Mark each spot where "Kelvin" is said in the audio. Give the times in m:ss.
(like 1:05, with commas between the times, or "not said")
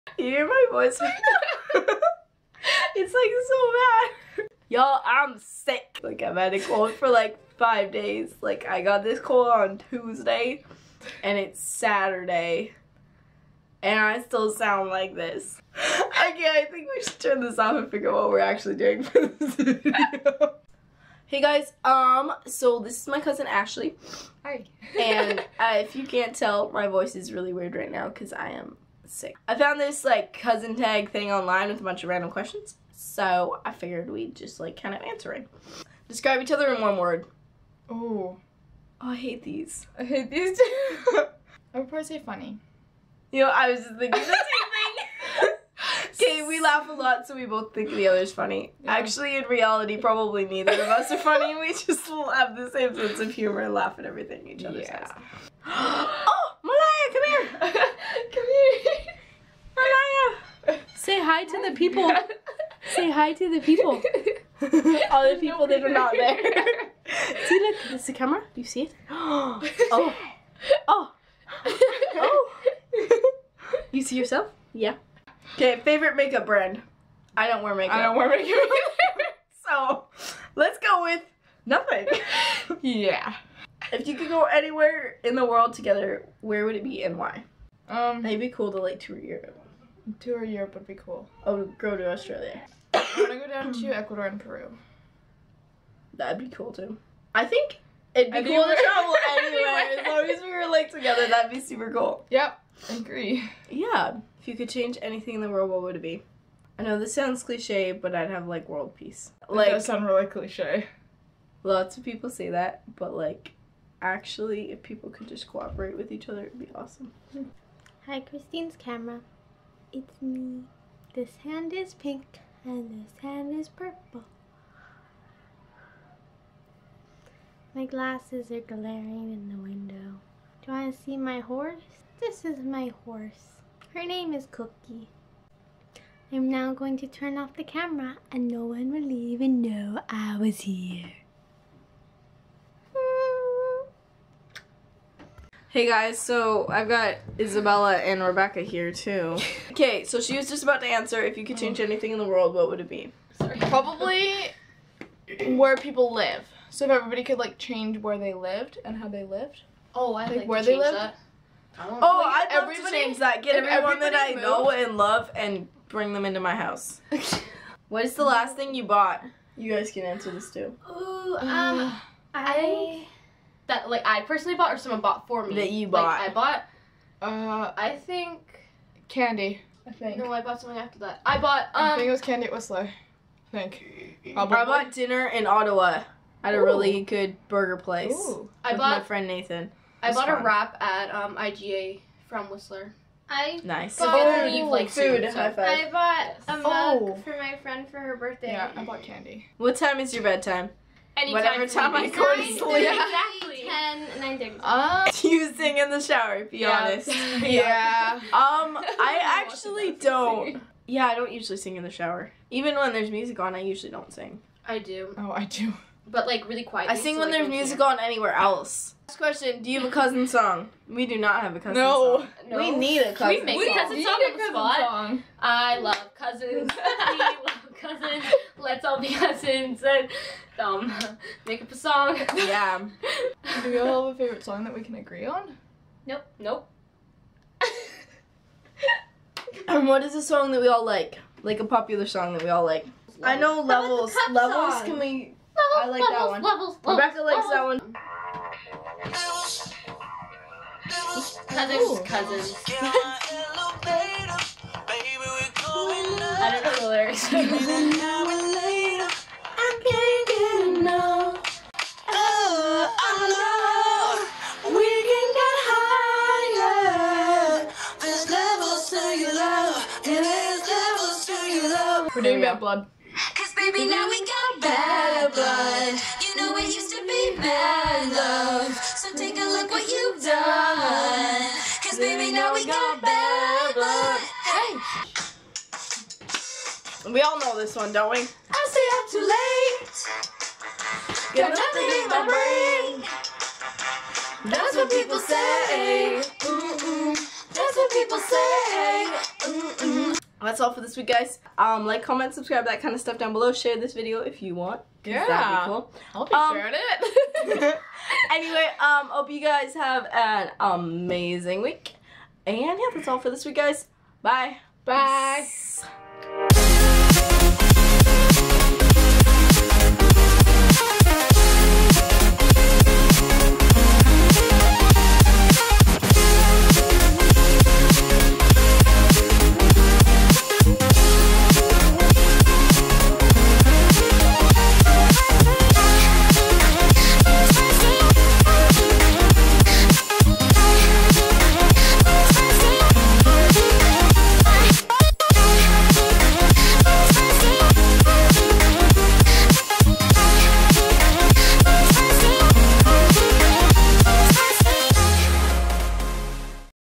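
not said.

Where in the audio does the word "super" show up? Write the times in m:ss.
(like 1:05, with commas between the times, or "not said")
1:41.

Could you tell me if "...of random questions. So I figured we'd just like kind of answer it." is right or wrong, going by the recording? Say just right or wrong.
right.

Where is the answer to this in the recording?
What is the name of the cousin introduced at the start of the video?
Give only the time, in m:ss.
0:23.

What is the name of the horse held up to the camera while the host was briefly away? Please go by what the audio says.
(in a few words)
Cookie.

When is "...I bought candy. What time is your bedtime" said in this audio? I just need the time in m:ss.
3:18.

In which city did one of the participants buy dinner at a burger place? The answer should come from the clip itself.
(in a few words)
Ottawa.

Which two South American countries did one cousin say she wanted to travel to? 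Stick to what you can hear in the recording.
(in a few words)
Ecuador and Peru.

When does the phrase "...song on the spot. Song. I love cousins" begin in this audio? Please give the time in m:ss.
3:44.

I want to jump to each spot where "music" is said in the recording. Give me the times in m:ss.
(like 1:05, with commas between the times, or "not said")
3:33, 3:37.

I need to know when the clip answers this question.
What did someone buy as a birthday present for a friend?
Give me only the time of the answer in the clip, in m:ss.
3:15.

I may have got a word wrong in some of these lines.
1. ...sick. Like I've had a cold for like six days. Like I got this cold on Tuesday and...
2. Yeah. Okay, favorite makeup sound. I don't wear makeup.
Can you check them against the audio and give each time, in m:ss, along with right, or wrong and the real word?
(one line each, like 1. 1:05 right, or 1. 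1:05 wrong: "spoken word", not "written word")
1. 0:05 wrong: "five", not "six"
2. 1:14 wrong: "brand", not "sound".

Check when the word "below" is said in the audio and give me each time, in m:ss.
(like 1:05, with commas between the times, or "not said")
5:03.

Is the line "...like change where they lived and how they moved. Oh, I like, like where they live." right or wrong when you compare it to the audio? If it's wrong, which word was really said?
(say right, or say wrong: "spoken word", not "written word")
wrong: "lived", not "moved".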